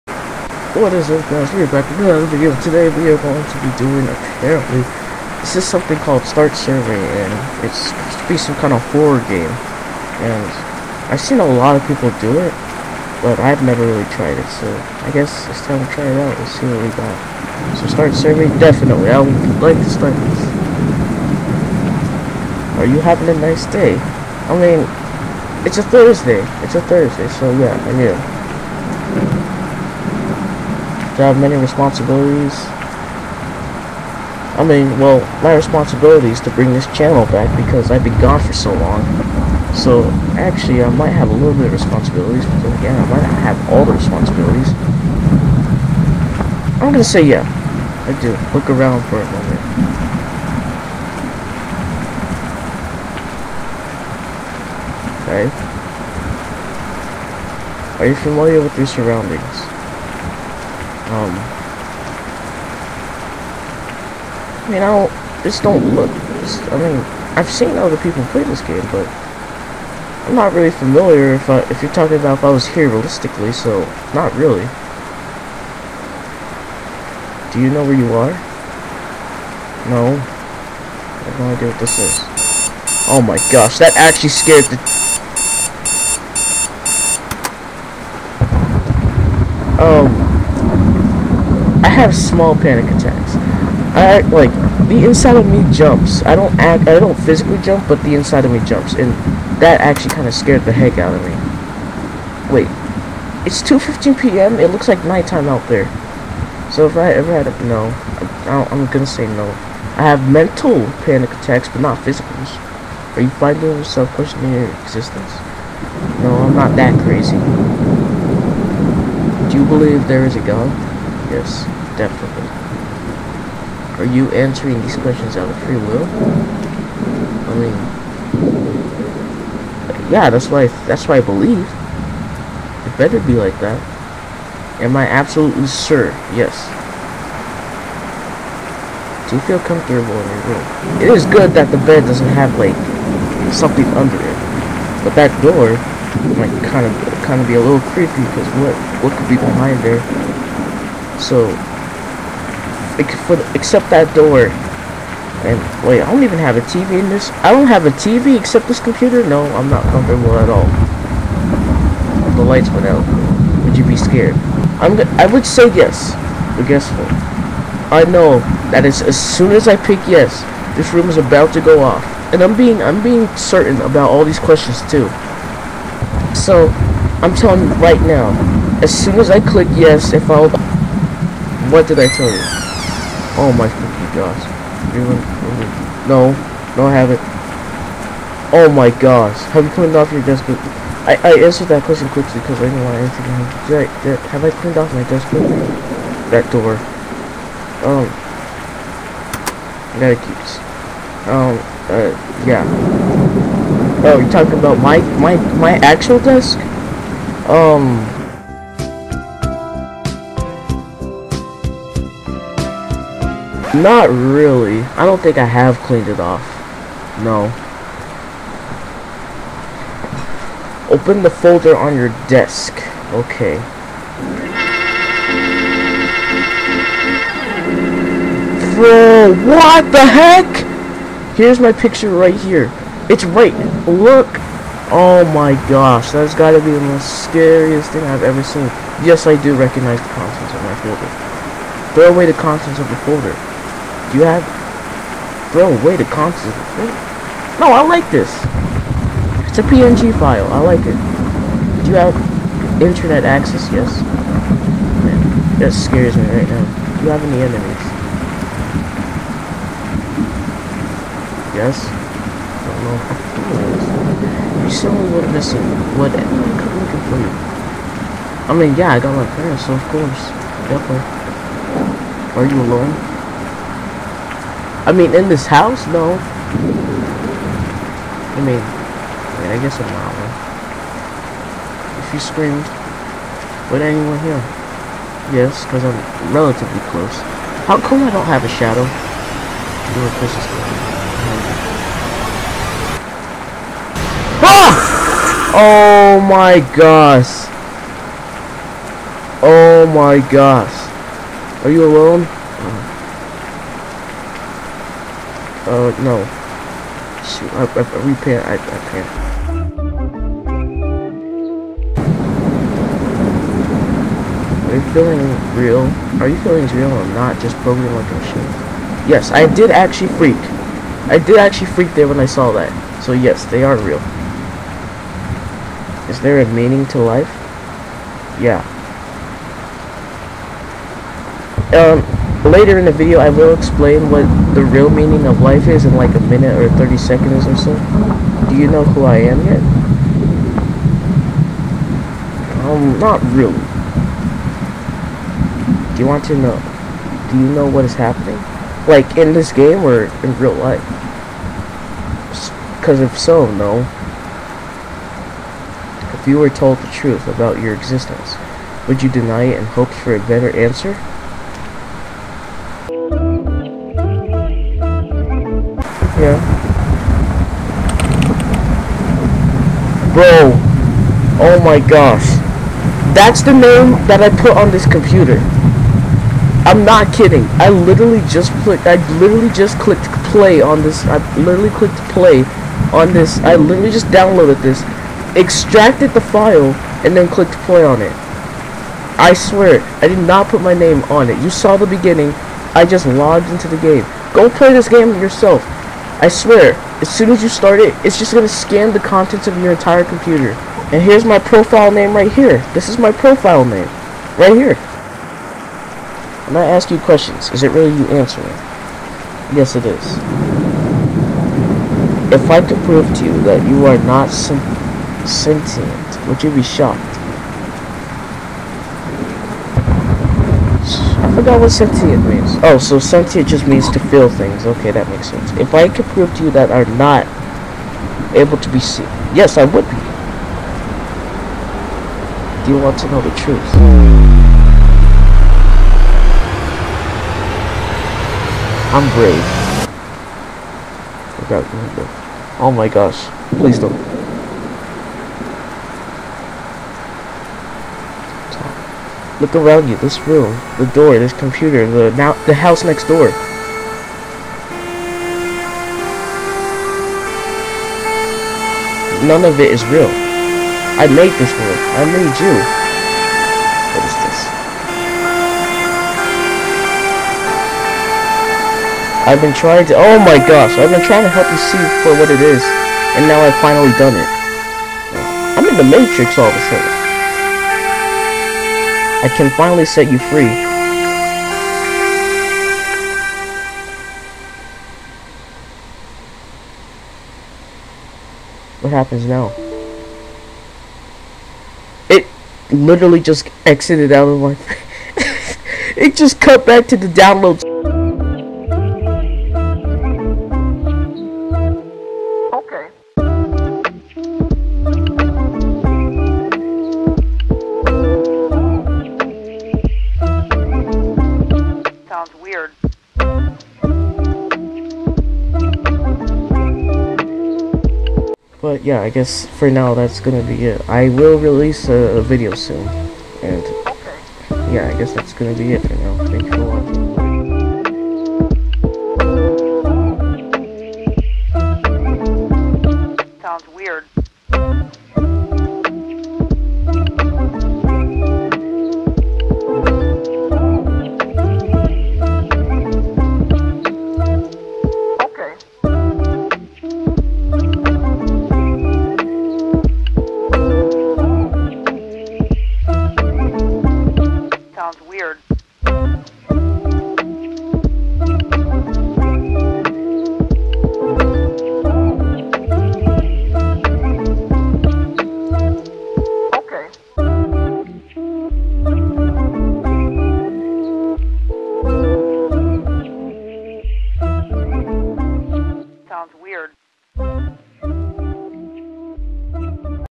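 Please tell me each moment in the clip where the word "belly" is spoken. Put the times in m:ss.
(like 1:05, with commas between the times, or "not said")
not said.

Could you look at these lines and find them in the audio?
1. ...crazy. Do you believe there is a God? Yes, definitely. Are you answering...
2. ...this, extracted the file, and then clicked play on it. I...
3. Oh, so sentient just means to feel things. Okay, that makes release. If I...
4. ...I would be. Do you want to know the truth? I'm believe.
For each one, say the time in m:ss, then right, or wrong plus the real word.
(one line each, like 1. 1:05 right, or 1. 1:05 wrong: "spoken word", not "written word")
1. 1:57 right
2. 6:24 right
3. 7:02 wrong: "sense", not "release"
4. 7:09 wrong: "brave", not "believe".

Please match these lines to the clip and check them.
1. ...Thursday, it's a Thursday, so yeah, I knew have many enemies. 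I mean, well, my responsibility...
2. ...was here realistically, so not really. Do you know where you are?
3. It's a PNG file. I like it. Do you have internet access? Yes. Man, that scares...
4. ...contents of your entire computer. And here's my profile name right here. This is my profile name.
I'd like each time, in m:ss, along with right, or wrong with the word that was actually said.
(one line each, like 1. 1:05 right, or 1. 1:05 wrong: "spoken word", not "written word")
1. 0:25 wrong: "responsibilities", not "enemies"
2. 1:12 right
3. 4:09 right
4. 6:38 right.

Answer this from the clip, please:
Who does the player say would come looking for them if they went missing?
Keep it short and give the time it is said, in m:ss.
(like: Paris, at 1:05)
my parents, at 4:29.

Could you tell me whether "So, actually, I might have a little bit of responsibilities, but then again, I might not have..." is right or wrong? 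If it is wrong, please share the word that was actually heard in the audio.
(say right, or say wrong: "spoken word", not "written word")
right.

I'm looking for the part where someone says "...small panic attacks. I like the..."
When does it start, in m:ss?
1:32.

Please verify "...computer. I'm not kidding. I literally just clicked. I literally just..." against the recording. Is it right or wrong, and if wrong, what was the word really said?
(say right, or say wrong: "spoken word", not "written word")
right.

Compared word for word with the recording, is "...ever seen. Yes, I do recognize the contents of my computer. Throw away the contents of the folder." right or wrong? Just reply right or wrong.
wrong.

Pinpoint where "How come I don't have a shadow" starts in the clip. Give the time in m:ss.
4:47.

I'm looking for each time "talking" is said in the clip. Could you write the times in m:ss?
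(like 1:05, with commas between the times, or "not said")
1:11, 3:24.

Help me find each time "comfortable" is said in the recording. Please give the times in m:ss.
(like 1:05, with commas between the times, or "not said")
2:19, 2:39.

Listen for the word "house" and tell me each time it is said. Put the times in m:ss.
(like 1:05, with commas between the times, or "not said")
4:35, 7:32.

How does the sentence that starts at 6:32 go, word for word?
I just logged into the game.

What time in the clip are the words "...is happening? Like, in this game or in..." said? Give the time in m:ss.
5:47.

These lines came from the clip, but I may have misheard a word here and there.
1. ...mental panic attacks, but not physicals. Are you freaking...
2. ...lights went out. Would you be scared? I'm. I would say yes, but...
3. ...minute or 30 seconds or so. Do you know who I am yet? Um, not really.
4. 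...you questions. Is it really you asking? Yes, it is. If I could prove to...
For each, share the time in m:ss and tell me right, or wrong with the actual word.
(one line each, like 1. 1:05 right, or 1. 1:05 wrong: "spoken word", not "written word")
1. 1:50 wrong: "finding", not "freaking"
2. 2:42 right
3. 5:36 right
4. 6:46 wrong: "answering", not "asking".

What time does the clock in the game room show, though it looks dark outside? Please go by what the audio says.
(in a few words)
2:15 p.m.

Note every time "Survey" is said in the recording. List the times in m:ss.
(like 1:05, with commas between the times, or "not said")
0:06, 0:18.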